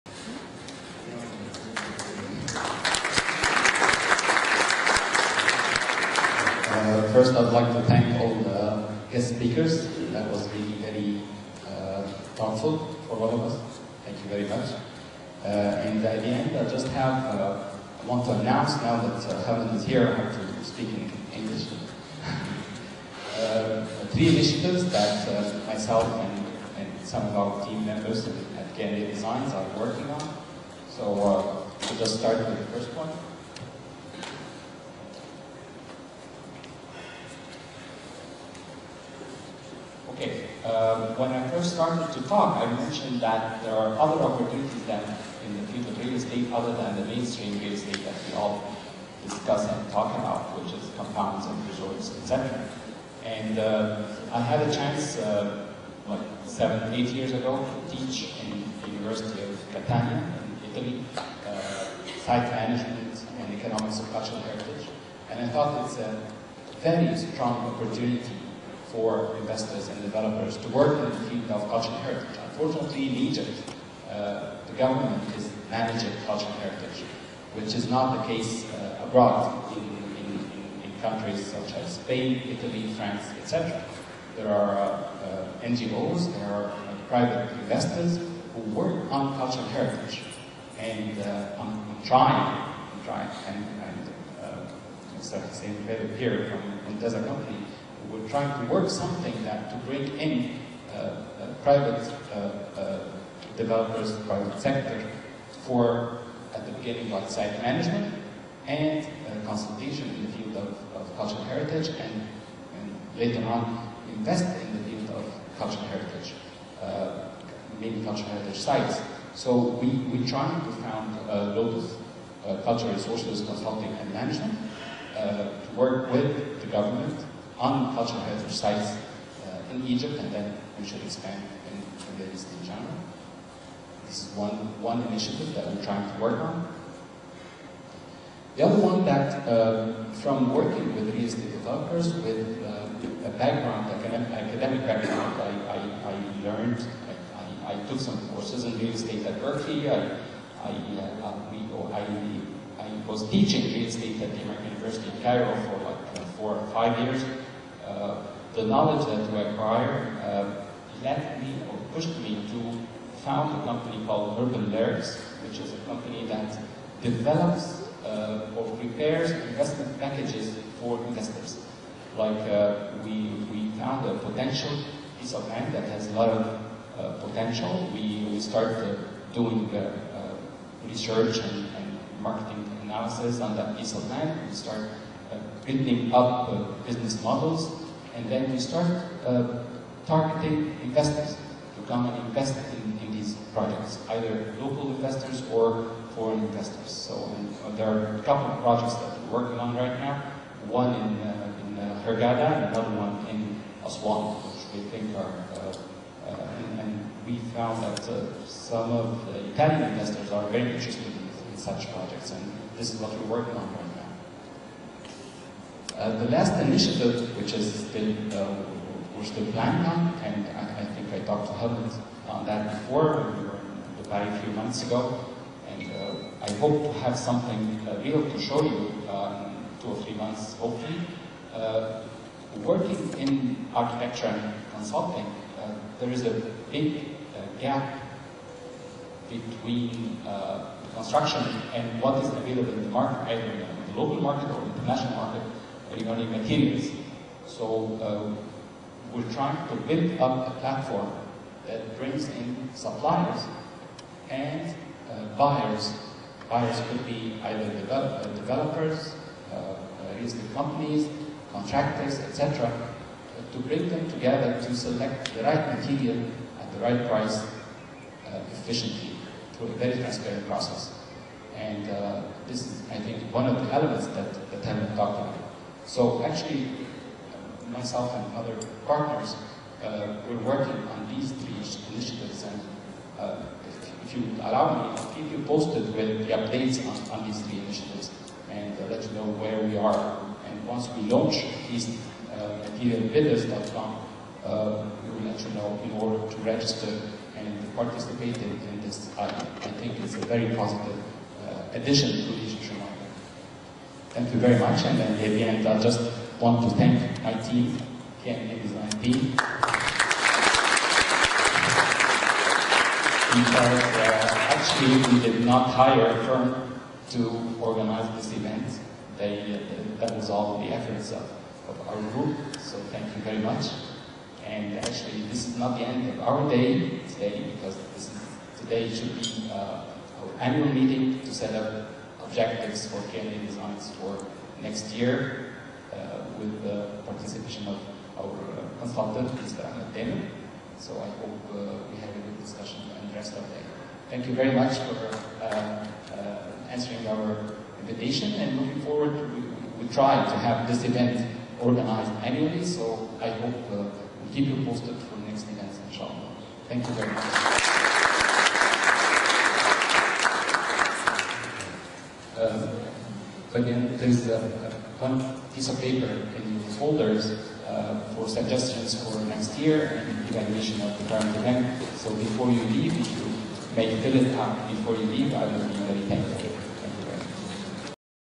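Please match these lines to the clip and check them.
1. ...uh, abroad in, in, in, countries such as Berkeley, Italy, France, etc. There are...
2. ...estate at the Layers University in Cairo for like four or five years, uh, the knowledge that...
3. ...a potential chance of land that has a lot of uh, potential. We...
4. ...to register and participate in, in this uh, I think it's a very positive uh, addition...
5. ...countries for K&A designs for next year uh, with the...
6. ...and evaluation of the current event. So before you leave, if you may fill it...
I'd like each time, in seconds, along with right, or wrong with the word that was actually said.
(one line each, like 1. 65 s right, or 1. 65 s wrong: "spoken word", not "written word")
1. 78 s wrong: "Spain", not "Berkeley"
2. 153 s wrong: "American", not "Layers"
3. 174 s wrong: "piece", not "chance"
4. 296 s right
5. 332 s wrong: "objectives", not "countries"
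6. 370 s right.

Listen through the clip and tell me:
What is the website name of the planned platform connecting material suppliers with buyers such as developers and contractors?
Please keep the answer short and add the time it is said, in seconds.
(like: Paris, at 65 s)
materialbidders.com, at 292 s.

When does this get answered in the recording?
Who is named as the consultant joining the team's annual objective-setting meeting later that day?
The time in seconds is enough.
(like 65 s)
339 s.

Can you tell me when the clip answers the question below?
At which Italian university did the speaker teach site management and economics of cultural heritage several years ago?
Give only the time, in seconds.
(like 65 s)
58 s.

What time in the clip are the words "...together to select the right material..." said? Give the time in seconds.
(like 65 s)
264 s.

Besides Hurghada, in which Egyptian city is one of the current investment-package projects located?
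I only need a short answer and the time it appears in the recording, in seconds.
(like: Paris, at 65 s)
Aswan, at 203 s.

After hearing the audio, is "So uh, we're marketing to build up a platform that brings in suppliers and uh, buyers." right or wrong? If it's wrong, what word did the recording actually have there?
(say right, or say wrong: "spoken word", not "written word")
wrong: "trying", not "marketing".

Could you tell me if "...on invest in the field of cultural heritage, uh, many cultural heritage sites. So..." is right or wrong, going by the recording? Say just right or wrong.
right.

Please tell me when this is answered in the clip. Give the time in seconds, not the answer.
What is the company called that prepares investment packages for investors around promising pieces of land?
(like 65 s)
164 s.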